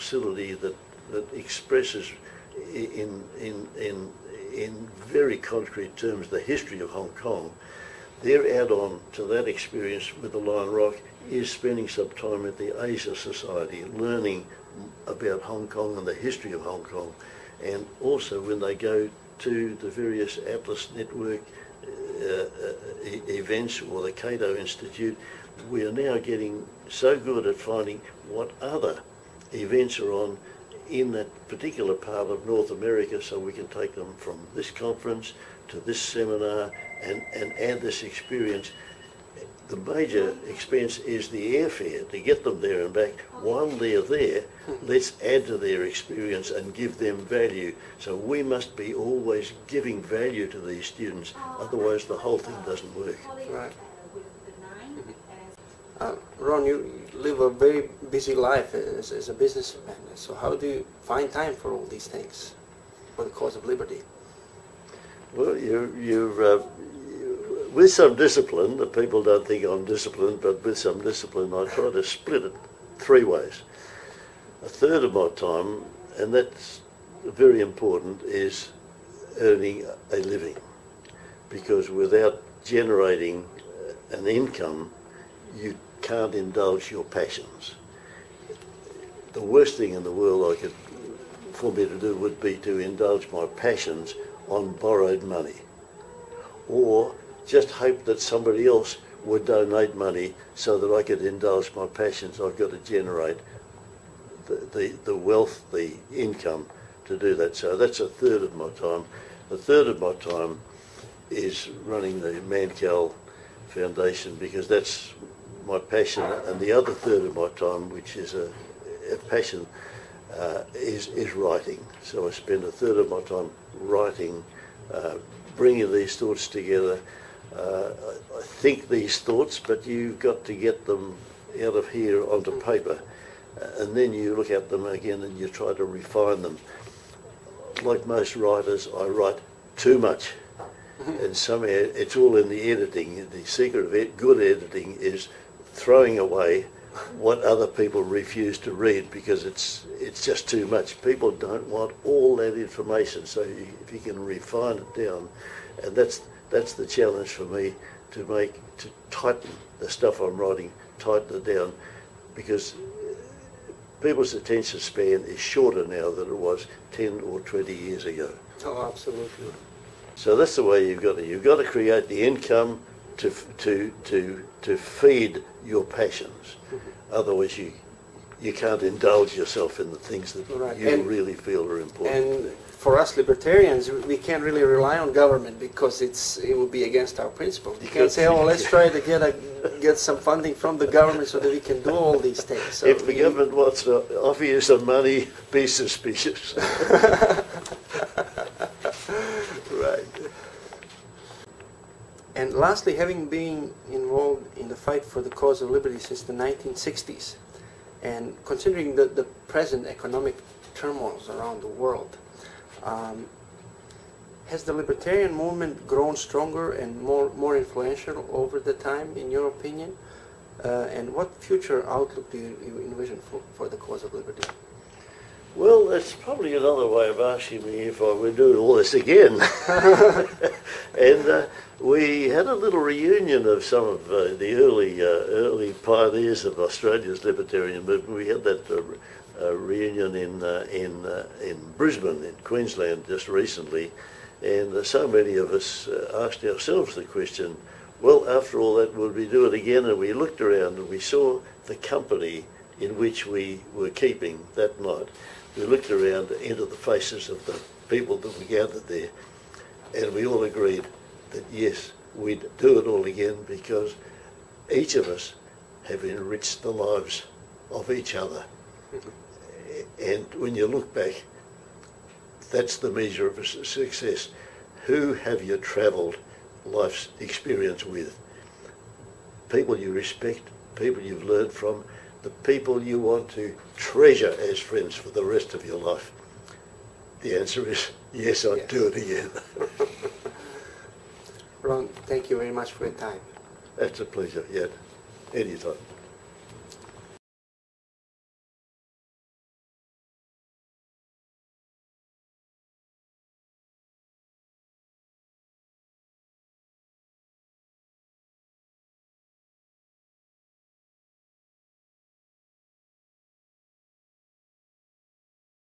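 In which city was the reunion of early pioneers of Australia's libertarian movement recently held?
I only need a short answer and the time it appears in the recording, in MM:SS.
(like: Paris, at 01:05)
Brisbane, at 04:01.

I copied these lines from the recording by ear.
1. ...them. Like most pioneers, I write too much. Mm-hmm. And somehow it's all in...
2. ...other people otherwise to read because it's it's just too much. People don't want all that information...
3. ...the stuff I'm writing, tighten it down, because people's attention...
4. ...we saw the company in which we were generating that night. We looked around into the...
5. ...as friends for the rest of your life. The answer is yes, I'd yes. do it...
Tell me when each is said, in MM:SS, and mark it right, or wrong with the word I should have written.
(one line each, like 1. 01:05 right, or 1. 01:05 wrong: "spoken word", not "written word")
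1. 02:16 wrong: "writers", not "pioneers"
2. 02:27 wrong: "refuse", not "otherwise"
3. 02:39 right
4. 04:10 wrong: "keeping", not "generating"
5. 04:44 right.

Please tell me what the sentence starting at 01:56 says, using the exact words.
And the other third of my time, which is a, a passion, uh, is, is writing.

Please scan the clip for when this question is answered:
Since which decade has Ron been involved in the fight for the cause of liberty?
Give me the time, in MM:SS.
03:26.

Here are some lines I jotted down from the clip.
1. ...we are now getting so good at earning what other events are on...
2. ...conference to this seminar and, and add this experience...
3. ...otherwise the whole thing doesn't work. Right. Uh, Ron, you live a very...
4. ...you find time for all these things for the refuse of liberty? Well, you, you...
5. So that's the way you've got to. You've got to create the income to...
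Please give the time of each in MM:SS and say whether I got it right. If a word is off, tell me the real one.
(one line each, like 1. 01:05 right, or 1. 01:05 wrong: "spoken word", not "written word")
1. 00:25 wrong: "finding", not "earning"
2. 00:34 right
3. 00:51 right
4. 01:00 wrong: "cause", not "refuse"
5. 02:50 right.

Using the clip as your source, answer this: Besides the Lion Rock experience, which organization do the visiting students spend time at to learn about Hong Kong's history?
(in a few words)
Asia Society.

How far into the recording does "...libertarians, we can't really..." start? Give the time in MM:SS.
03:03.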